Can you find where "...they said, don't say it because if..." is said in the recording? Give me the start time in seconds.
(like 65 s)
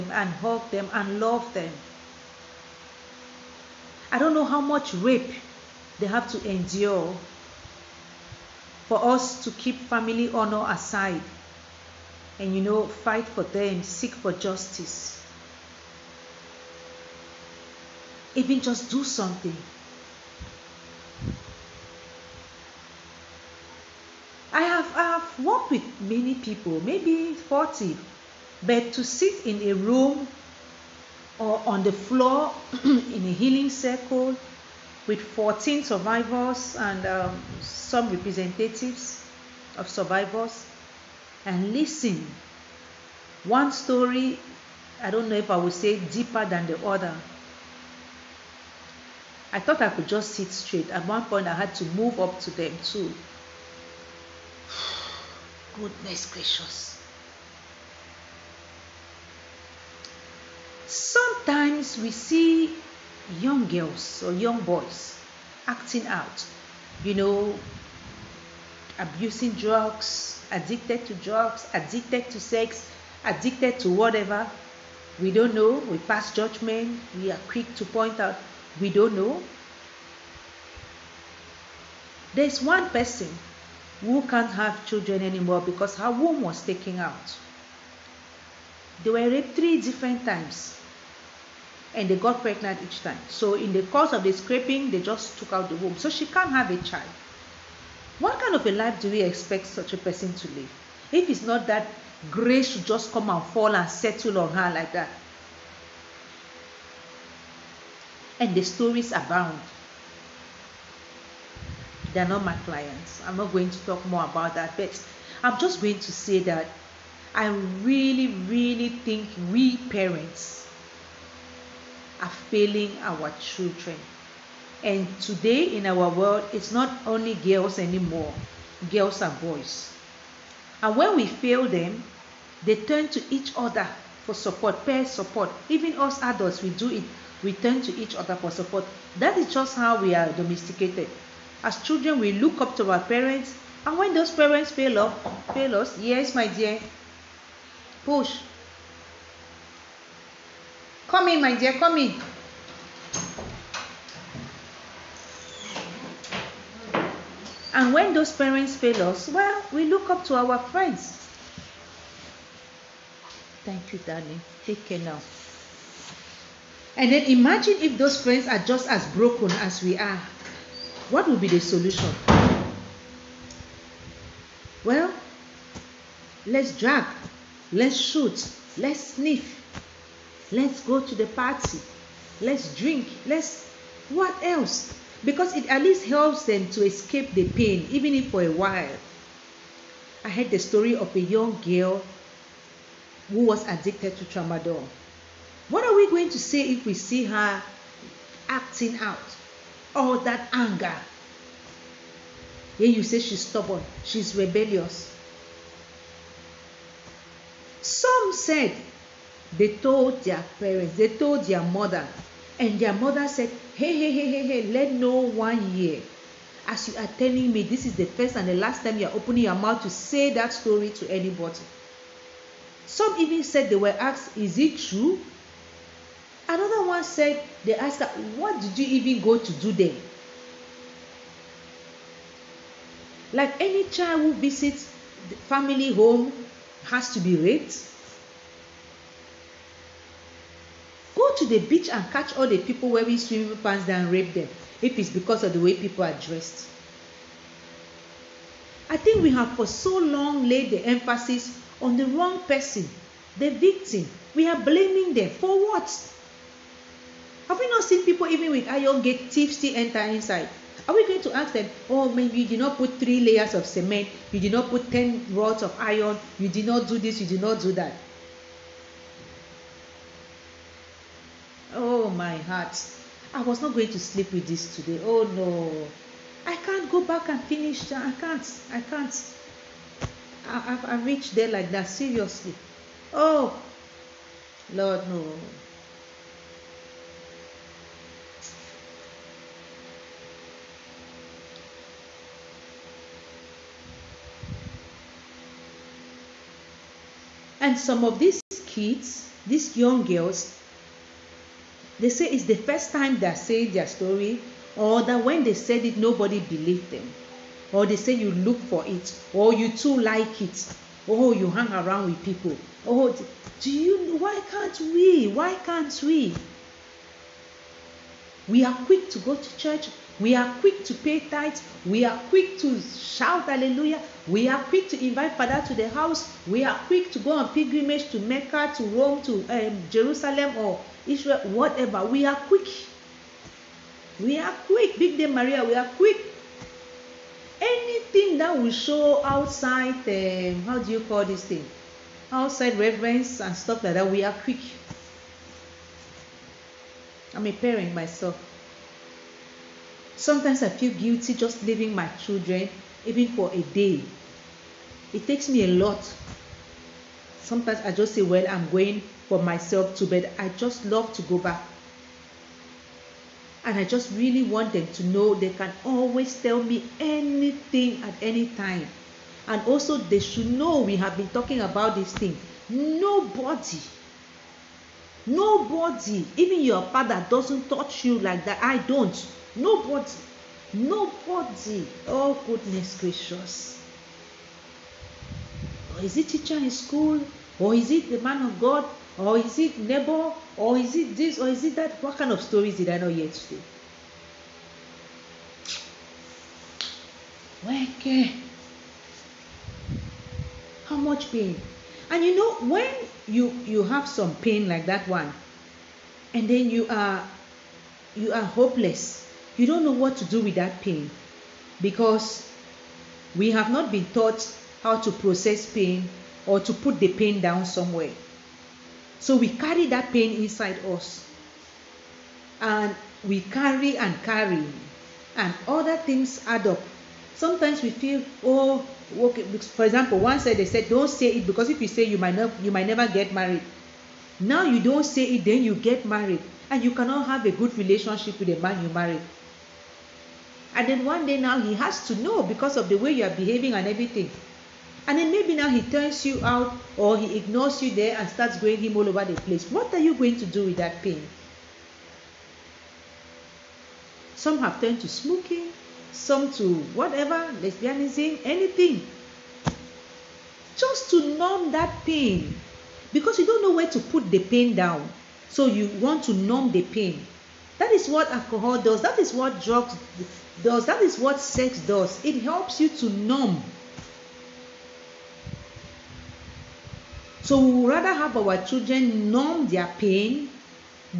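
430 s.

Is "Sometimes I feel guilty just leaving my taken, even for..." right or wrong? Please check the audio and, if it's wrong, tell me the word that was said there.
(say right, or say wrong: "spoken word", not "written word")
wrong: "children", not "taken".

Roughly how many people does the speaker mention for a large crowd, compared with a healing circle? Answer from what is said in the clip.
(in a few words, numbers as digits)
40.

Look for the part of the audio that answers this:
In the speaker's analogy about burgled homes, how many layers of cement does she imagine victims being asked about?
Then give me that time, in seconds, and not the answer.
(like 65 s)
262 s.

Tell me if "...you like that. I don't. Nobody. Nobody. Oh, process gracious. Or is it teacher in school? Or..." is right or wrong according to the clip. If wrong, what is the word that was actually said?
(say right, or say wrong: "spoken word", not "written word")
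wrong: "goodness", not "process".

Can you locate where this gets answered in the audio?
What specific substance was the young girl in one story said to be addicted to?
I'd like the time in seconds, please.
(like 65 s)
194 s.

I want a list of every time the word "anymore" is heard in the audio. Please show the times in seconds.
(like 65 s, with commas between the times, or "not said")
85 s, 127 s.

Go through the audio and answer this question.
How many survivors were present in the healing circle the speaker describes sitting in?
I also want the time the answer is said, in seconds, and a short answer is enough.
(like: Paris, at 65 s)
14, at 35 s.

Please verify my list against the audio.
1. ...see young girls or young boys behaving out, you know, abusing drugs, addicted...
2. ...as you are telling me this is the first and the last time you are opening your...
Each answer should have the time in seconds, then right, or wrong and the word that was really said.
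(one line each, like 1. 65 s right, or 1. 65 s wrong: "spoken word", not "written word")
1. 62 s wrong: "acting", not "behaving"
2. 216 s right.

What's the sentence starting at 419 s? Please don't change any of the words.
So we carry that pain inside us.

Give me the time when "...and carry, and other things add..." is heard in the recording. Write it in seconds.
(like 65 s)
423 s.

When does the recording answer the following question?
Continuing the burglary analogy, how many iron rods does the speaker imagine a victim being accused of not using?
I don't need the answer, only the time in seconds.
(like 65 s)
264 s.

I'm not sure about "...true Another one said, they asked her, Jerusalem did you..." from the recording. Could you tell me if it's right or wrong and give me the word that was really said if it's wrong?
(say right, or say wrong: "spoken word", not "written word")
wrong: "What", not "Jerusalem".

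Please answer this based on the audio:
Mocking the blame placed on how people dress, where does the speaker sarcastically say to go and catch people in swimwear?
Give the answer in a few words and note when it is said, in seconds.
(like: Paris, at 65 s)
the beach, at 241 s.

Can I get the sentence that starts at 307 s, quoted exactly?
Or they say you look for it, or you too like it, or oh, you hang around with people.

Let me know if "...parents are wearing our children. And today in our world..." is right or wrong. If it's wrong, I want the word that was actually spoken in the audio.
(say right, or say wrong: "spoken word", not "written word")
wrong: "failing", not "wearing".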